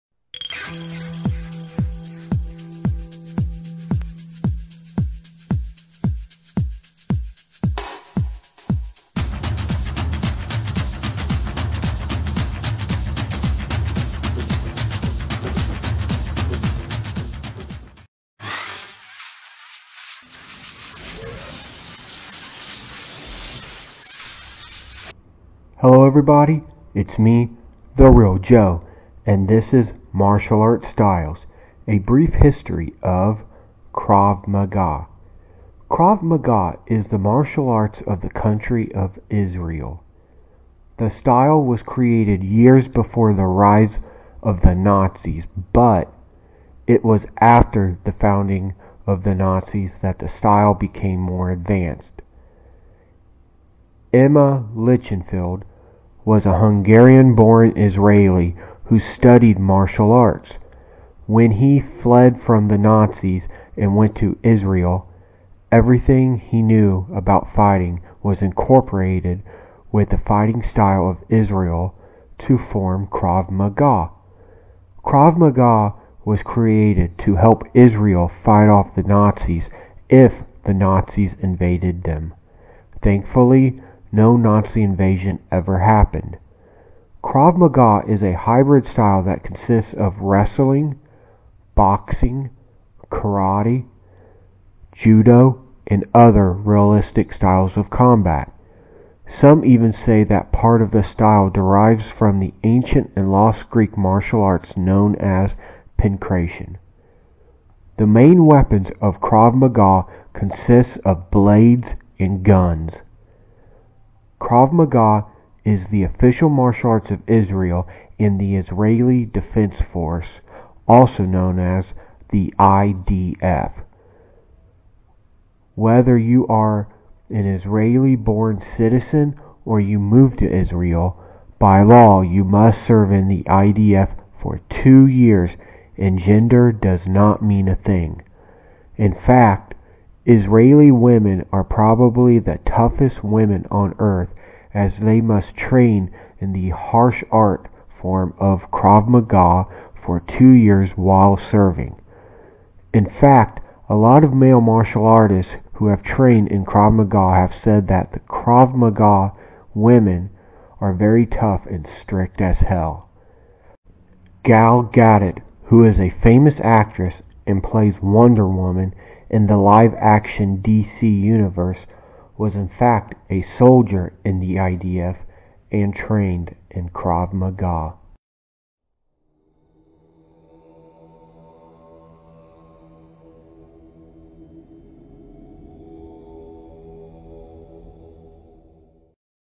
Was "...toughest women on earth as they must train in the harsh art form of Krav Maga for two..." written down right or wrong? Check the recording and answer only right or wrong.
right.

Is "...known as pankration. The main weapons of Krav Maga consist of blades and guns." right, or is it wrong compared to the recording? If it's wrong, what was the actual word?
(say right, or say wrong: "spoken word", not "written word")
right.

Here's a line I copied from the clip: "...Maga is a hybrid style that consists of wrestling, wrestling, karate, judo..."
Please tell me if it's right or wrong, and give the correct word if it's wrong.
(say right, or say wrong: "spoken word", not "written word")
wrong: "boxing", not "wrestling".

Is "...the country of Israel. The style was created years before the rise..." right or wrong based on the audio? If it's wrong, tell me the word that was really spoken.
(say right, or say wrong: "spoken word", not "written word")
right.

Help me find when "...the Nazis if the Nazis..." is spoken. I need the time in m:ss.
1:18.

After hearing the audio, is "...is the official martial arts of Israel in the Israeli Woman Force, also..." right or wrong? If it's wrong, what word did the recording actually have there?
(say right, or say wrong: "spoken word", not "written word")
wrong: "Defense", not "Woman".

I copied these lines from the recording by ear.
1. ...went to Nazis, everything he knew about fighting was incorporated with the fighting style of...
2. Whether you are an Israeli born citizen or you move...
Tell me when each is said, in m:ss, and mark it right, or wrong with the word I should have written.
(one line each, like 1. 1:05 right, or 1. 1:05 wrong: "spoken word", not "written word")
1. 1:03 wrong: "Israel", not "Nazis"
2. 2:05 right.